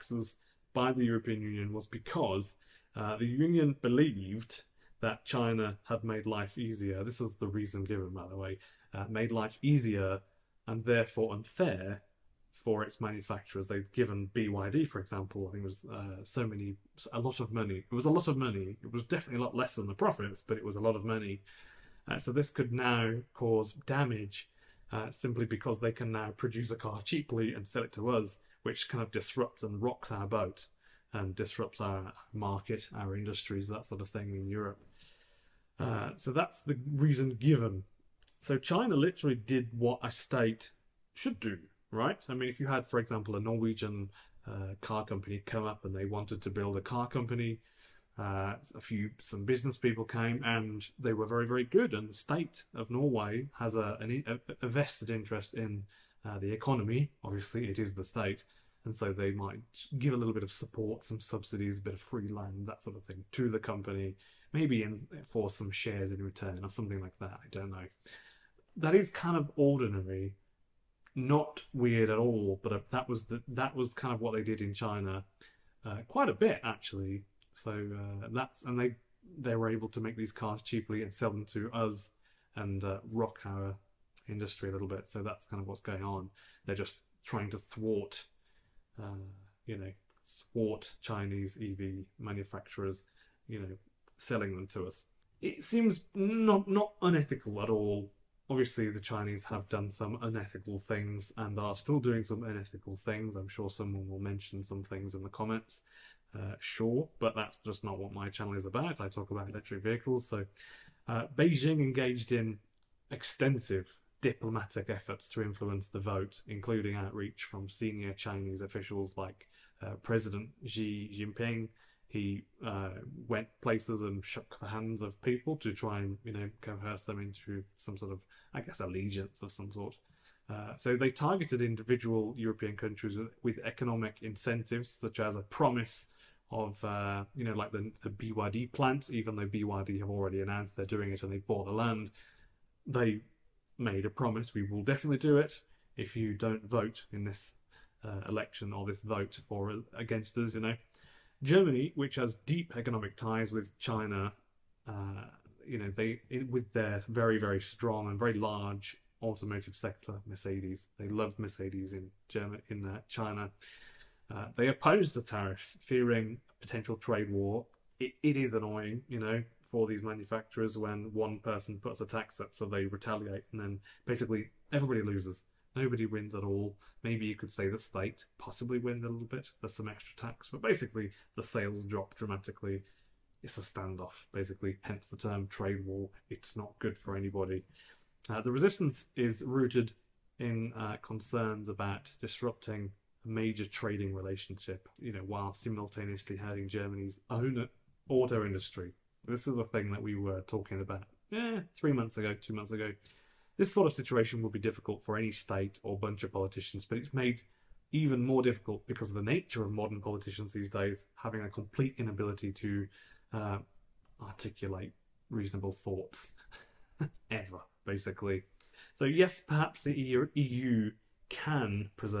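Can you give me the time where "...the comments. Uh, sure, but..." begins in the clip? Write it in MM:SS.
01:45.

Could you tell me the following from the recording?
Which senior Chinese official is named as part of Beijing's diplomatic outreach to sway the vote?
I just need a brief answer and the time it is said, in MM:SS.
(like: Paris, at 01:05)
Xi Jinping, at 02:00.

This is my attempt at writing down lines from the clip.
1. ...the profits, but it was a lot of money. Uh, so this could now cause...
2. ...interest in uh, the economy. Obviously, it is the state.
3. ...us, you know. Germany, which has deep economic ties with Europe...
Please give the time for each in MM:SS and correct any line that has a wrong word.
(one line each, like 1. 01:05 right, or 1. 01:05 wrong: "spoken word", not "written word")
1. 00:19 right
2. 00:55 right
3. 02:30 wrong: "China", not "Europe".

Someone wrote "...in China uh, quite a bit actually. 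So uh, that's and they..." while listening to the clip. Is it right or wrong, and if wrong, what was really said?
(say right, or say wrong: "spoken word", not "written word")
right.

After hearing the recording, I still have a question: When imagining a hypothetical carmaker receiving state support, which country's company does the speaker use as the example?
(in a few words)
Norway.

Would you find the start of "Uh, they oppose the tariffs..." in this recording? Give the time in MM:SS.
02:44.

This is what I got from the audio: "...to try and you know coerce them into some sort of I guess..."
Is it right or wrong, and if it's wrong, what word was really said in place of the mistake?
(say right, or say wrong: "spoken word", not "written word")
right.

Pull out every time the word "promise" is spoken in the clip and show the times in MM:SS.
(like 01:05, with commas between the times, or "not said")
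02:15, 02:24.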